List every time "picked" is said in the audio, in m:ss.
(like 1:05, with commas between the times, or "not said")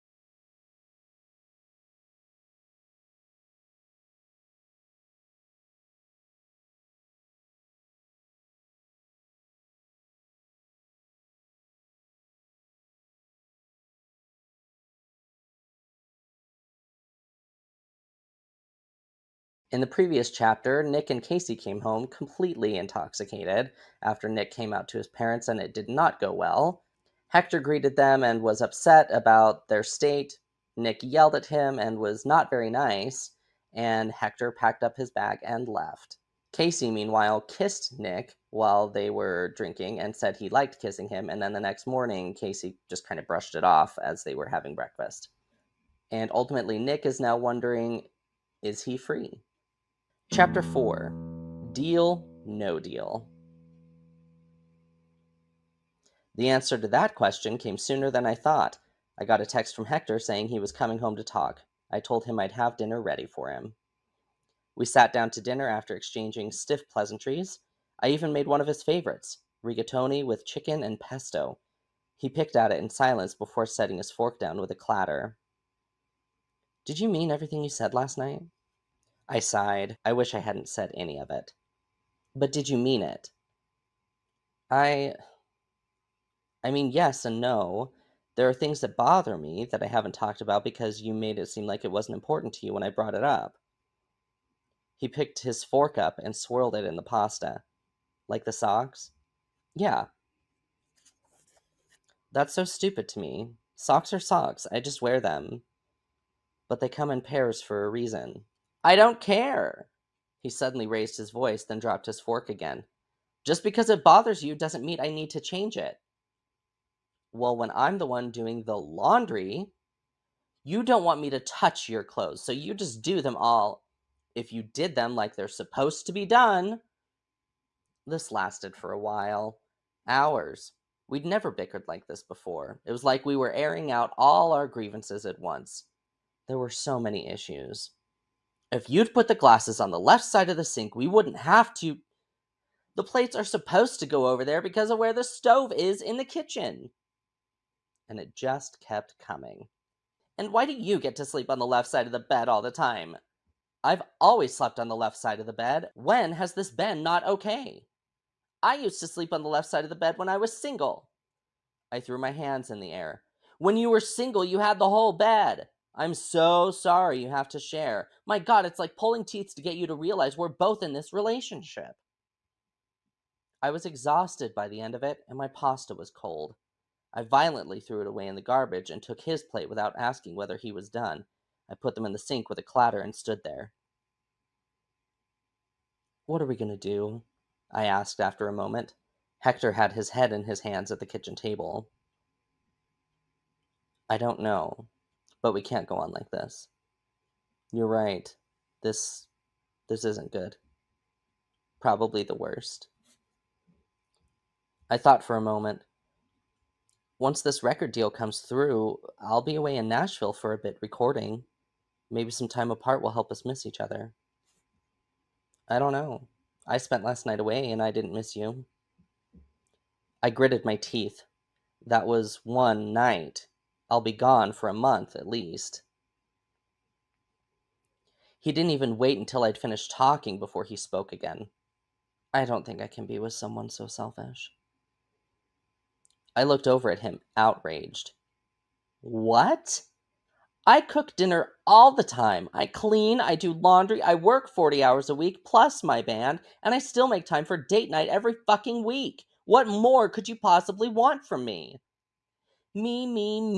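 1:12, 1:35.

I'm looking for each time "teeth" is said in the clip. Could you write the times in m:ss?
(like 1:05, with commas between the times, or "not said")
2:49, 3:40.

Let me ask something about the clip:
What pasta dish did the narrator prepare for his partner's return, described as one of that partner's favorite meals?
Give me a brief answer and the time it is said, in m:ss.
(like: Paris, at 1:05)
Rigatoni with chicken and pesto, at 1:09.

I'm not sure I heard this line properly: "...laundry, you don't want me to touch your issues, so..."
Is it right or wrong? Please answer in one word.
wrong.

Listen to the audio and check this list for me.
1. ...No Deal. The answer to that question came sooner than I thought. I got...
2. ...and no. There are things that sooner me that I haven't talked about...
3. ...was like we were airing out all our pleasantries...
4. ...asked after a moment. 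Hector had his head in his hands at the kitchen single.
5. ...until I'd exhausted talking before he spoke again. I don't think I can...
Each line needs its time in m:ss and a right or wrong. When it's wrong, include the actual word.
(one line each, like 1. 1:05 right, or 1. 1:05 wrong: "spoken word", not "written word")
1. 0:52 right
2. 1:27 wrong: "bother", not "sooner"
3. 2:12 wrong: "grievances", not "pleasantries"
4. 3:07 wrong: "table", not "single"
5. 3:49 wrong: "finished", not "exhausted".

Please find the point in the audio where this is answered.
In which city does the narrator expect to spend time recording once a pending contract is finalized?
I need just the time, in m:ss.
3:29.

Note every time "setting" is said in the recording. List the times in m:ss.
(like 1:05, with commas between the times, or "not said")
1:13.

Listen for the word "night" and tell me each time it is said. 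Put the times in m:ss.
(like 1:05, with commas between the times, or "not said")
1:18, 3:37, 3:42, 4:07.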